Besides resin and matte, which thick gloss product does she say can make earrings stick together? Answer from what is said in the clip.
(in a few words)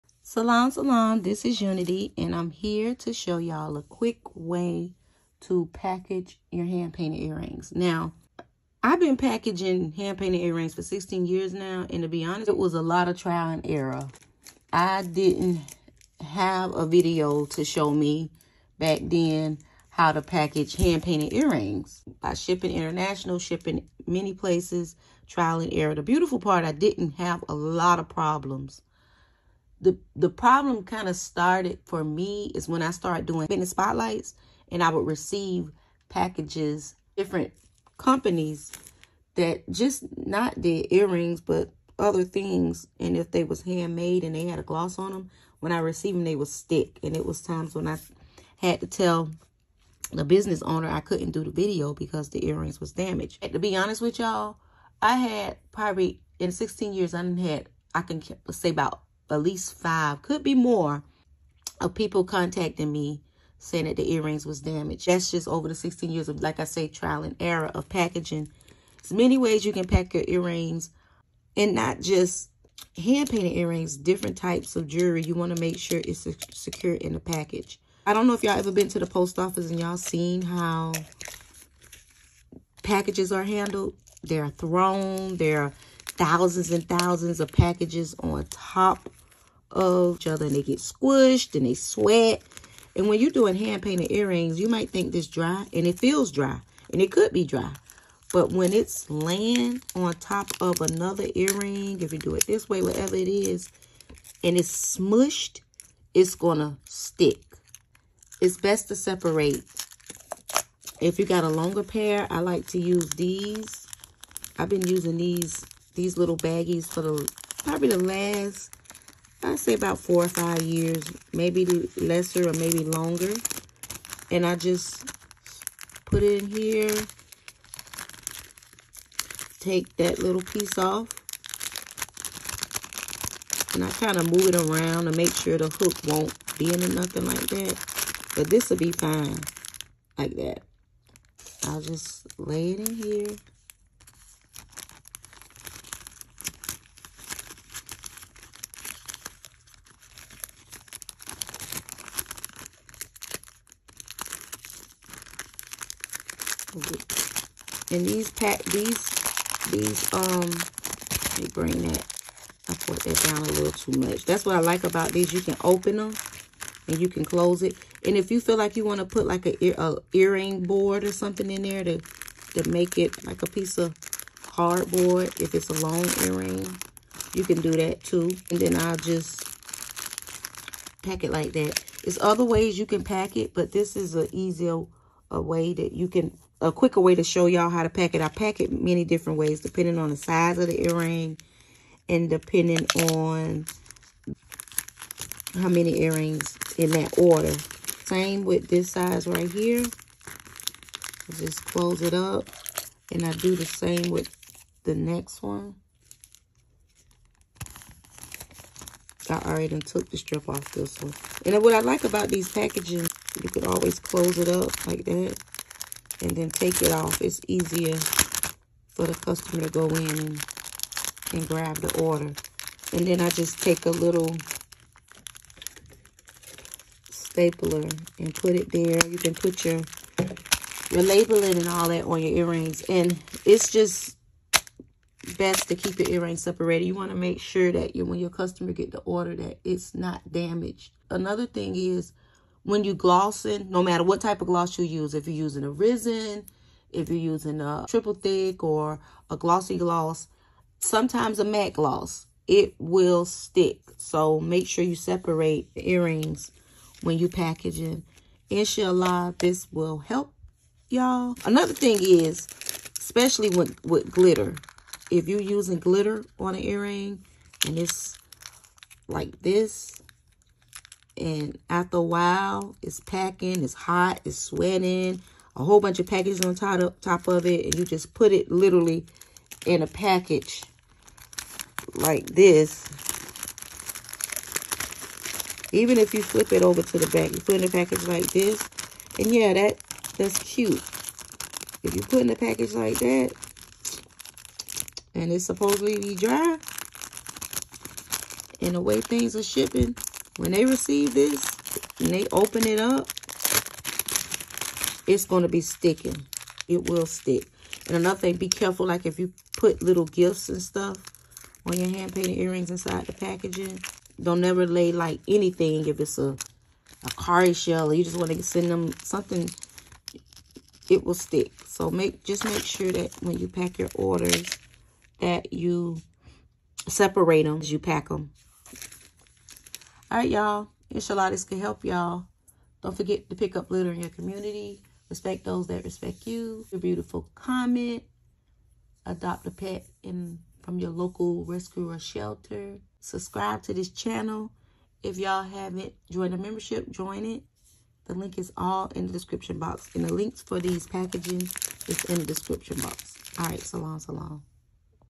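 triple thick.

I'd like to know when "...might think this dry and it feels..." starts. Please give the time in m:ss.
1:34.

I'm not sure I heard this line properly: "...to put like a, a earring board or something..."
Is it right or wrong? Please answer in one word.
right.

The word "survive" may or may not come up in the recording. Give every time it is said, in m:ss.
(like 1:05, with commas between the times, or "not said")
not said.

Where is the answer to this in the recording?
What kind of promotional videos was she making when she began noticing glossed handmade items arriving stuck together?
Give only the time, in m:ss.
0:33.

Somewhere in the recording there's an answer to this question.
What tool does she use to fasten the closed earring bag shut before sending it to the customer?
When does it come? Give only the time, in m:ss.
3:43.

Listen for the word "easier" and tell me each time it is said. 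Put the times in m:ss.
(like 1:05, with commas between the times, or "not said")
3:04, 3:37.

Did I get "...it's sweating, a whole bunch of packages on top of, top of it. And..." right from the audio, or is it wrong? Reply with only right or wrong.
right.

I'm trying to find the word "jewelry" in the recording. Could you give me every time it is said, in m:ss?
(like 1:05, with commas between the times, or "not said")
1:14.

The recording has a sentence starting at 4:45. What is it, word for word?
Even if you flip it over to the back, you put in a package like this.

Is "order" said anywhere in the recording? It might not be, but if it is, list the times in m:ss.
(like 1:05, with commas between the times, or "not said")
3:17, 3:42, 3:58, 5:23.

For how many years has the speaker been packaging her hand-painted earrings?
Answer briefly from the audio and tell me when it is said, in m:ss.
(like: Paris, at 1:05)
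16, at 0:10.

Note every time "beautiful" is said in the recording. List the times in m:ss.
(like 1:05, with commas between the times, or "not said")
0:26, 5:36.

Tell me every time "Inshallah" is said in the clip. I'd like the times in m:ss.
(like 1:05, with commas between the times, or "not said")
4:18, 5:30.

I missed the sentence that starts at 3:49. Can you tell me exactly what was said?
You can put your, your labeling and all that on your earrings.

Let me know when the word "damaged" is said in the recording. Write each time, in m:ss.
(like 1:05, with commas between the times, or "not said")
0:52, 1:04, 4:00.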